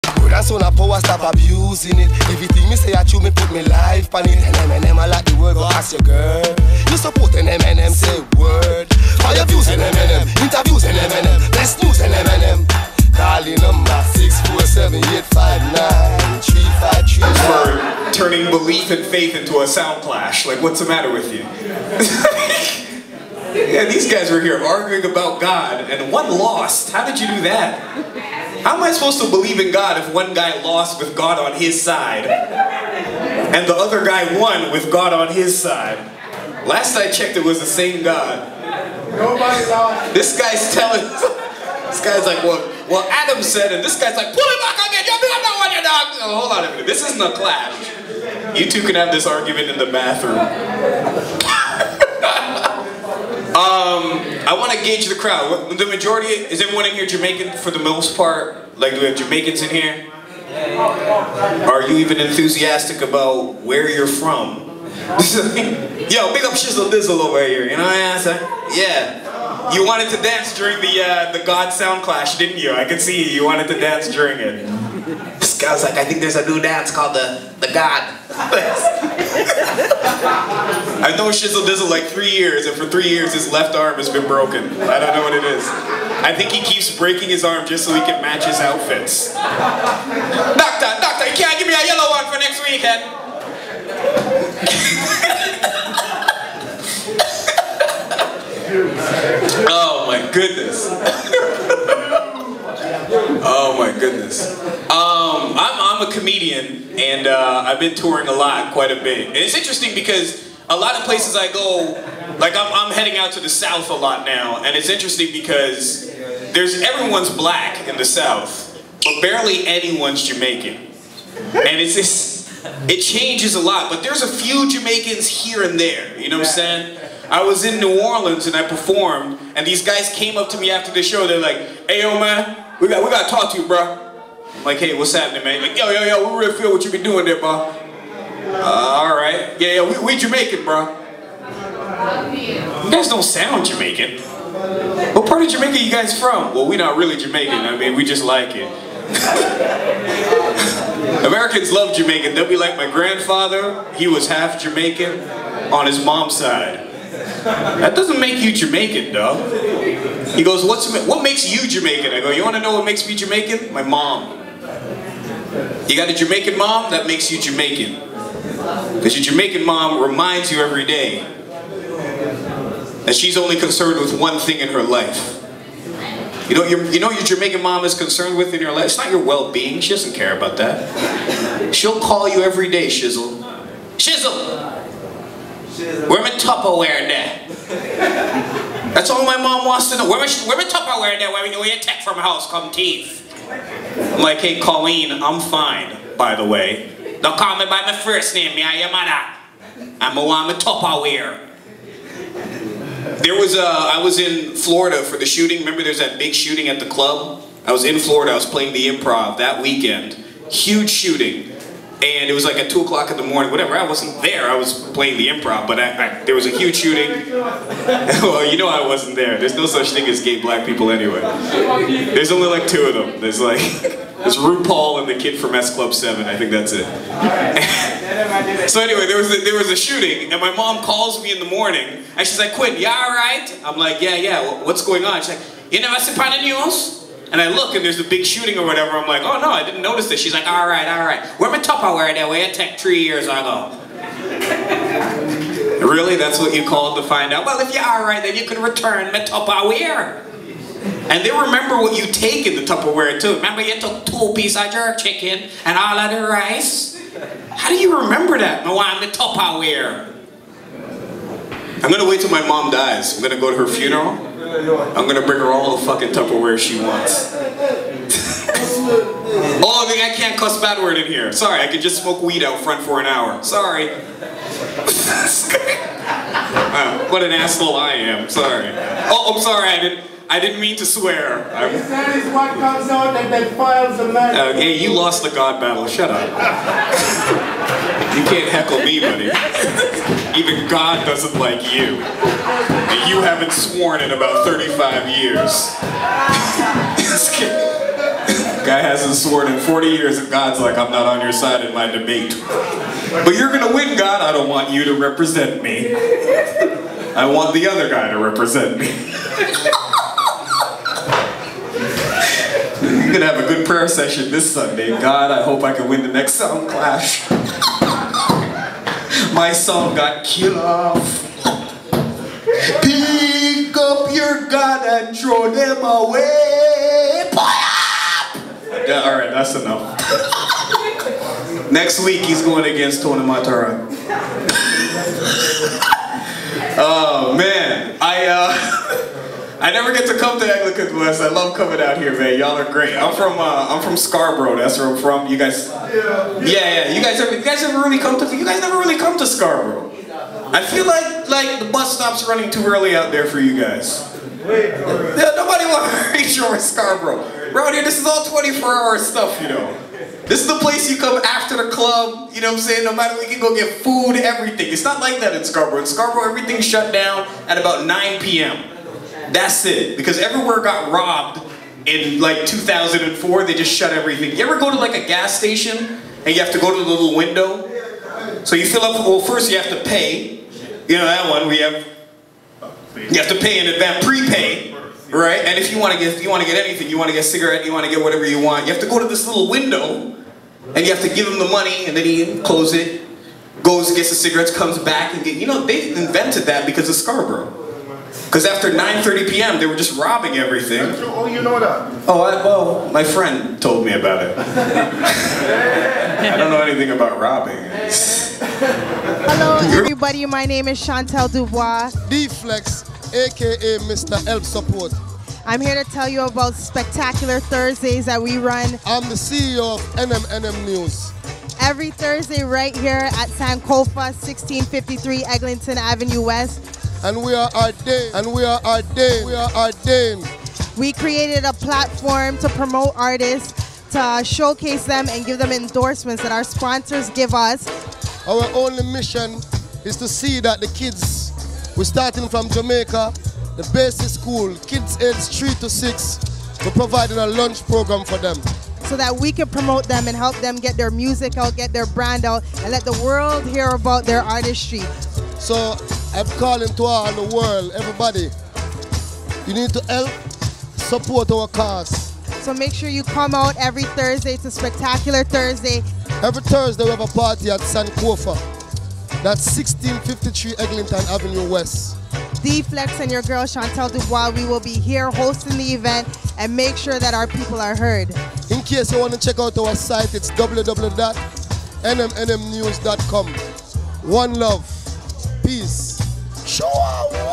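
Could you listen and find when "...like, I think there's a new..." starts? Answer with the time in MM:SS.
01:15.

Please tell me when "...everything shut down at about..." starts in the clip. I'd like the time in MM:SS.
06:06.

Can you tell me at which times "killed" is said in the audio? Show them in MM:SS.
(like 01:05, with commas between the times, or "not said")
05:20.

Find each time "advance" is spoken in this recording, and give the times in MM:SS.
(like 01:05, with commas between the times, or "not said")
06:23.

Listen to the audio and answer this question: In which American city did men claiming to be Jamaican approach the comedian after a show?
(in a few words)
New Orleans.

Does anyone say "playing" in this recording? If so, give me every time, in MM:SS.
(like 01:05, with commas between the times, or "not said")
03:28, 03:34.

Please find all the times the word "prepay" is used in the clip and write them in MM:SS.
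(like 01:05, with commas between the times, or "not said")
06:24.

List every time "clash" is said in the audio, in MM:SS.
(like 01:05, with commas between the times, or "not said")
00:20, 00:47, 01:12, 05:16.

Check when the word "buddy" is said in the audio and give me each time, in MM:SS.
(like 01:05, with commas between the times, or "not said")
04:48.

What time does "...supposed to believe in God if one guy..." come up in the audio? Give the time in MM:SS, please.
00:28.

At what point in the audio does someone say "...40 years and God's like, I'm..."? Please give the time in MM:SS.
04:59.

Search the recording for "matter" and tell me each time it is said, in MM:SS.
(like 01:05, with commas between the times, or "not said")
00:20, 06:02.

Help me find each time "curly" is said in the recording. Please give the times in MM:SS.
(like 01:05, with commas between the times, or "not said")
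not said.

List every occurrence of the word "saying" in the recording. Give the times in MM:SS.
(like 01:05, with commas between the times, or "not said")
01:08, 02:06, 06:02.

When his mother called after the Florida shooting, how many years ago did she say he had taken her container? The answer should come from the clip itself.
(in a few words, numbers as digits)
3.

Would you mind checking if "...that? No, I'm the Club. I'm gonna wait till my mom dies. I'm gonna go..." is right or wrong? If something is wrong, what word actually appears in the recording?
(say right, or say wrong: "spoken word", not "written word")
wrong: "Tupperware", not "Club".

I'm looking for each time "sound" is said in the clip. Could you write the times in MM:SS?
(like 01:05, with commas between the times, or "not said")
00:19, 01:11, 02:23.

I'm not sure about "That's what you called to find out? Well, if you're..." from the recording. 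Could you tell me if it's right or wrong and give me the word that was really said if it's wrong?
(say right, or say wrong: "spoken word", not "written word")
right.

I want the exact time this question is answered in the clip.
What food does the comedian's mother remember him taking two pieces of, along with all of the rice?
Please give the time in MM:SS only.
04:14.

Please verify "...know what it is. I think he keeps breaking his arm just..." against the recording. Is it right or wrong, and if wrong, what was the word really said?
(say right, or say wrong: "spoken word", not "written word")
right.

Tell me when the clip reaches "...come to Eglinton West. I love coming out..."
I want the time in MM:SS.
05:40.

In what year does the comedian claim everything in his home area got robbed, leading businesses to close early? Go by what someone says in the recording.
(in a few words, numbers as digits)
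2004.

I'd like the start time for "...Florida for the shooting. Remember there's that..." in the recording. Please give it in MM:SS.
03:24.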